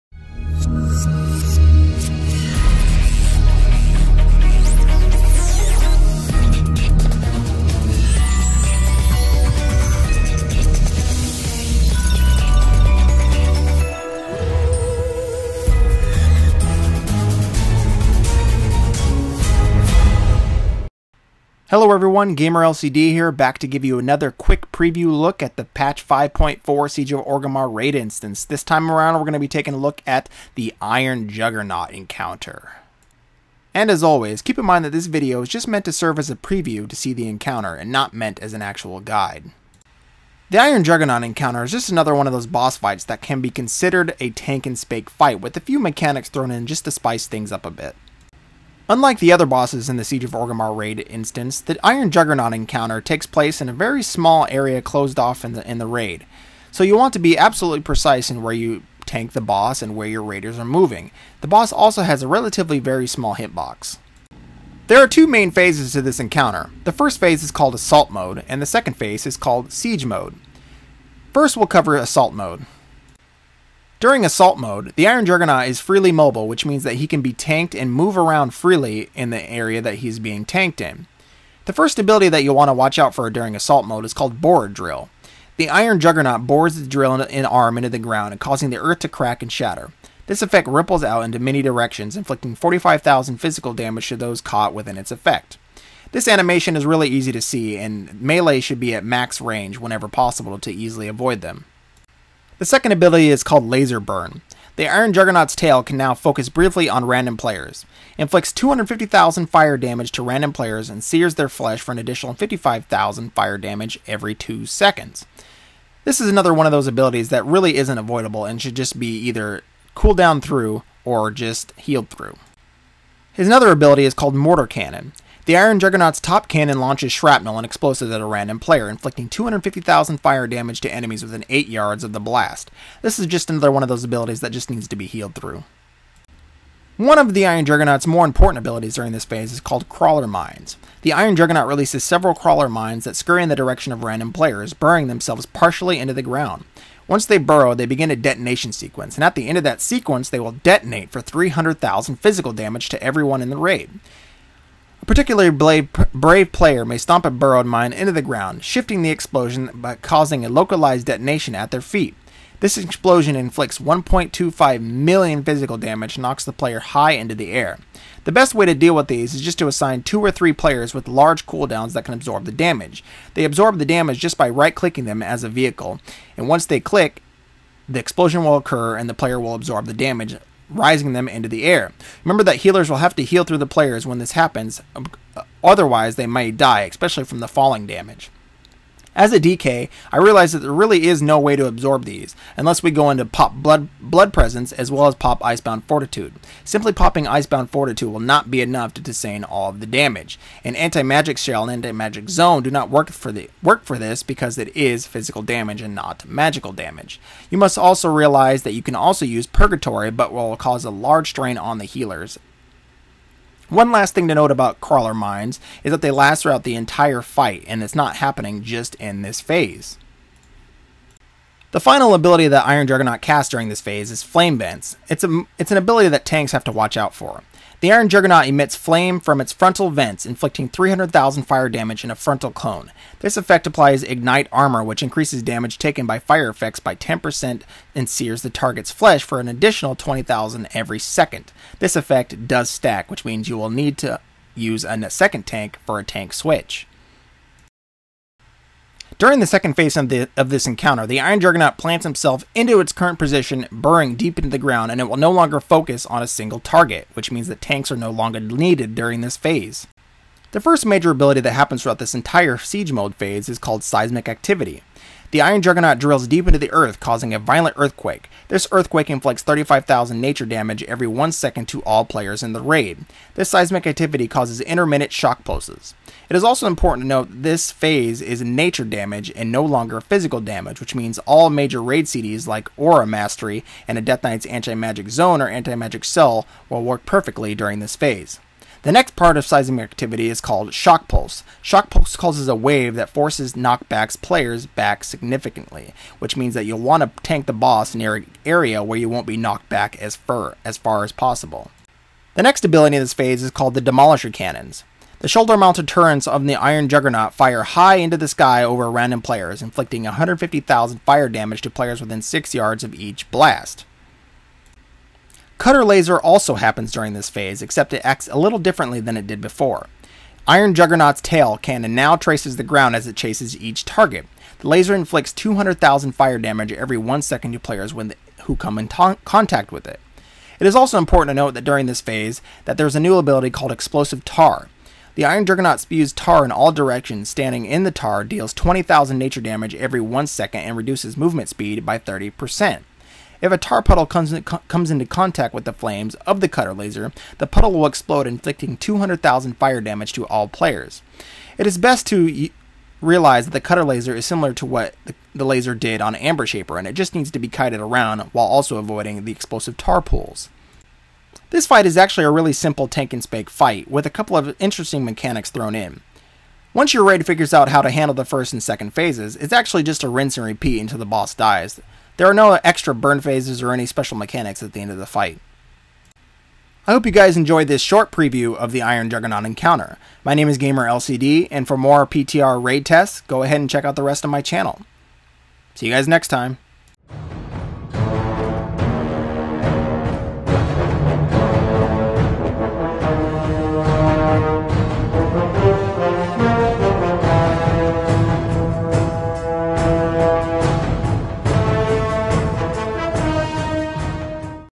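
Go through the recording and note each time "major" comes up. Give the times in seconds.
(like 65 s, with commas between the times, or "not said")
260 s, 281 s.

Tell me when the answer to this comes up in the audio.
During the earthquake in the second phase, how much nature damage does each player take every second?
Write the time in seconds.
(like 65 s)
269 s.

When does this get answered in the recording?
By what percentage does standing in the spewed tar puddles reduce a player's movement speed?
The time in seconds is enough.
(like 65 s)
341 s.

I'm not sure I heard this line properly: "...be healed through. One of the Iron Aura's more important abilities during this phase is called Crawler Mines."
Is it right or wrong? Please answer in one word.
wrong.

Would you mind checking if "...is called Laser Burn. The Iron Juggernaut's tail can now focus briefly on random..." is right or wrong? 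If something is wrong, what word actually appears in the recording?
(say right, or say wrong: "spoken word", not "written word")
right.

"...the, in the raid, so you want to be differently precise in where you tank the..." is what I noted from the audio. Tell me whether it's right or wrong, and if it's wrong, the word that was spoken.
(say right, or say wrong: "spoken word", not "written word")
wrong: "absolutely", not "differently".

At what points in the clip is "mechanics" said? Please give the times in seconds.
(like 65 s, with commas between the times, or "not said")
45 s, 365 s, 374 s.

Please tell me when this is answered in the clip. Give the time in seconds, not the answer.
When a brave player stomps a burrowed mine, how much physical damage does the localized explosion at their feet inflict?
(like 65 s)
163 s.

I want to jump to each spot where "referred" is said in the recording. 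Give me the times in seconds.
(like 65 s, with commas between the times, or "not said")
not said.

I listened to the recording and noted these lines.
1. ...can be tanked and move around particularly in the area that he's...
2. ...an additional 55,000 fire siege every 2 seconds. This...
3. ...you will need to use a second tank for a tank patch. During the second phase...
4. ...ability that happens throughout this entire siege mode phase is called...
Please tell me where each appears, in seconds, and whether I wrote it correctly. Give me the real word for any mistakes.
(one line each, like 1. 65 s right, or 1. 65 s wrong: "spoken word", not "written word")
1. 77 s wrong: "freely", not "particularly"
2. 111 s wrong: "damage", not "siege"
3. 243 s wrong: "switch", not "patch"
4. 261 s right.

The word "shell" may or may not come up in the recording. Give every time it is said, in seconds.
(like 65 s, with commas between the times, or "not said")
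201 s, 286 s.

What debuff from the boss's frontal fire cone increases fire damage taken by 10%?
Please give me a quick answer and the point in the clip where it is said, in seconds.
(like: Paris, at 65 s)
Ignite Armor, at 234 s.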